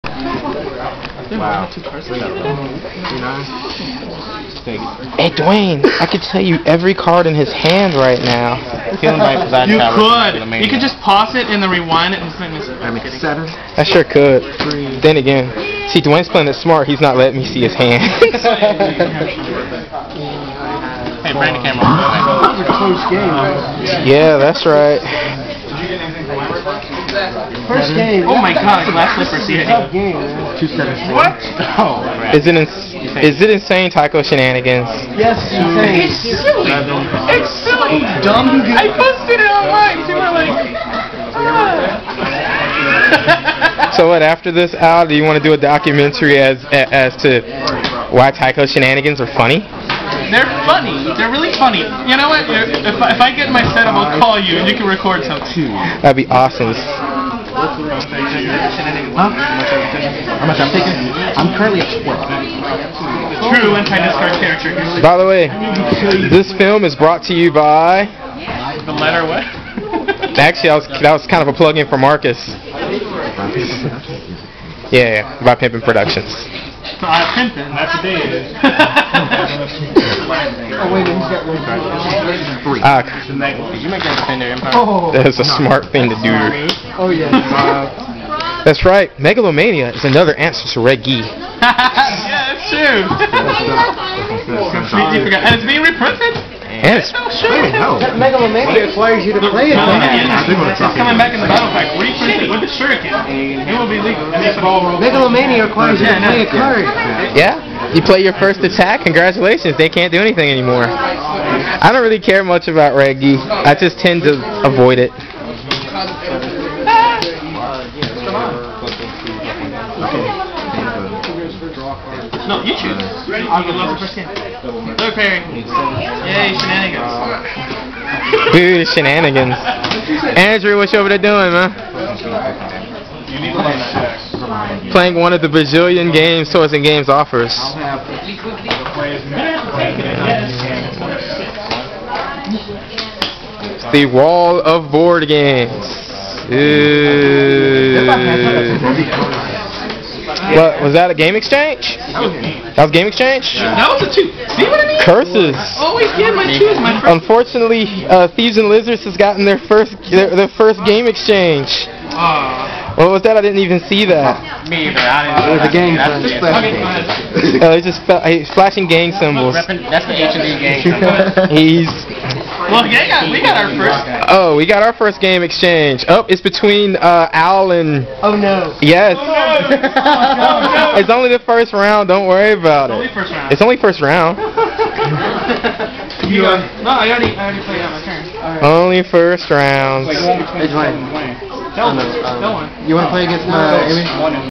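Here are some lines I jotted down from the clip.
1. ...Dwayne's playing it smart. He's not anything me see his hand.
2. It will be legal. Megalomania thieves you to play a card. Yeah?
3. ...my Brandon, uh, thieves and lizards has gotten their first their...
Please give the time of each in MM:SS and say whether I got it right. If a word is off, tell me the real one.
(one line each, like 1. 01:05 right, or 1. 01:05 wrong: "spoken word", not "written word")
1. 00:16 wrong: "letting", not "anything"
2. 01:43 wrong: "requires", not "thieves"
3. 02:36 wrong: "Unfortunately", not "Brandon".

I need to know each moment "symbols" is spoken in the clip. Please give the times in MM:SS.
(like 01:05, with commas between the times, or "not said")
02:49.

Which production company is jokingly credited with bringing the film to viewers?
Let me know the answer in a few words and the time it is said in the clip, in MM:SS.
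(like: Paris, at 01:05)
Pimpin' Productions, at 01:15.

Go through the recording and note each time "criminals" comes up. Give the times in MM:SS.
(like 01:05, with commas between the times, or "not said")
not said.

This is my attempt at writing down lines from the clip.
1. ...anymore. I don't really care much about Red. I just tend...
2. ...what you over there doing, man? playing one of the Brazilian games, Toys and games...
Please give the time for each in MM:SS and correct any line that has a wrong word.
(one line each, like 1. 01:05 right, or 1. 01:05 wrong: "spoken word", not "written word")
1. 01:50 wrong: "Reggie", not "Red"
2. 02:10 right.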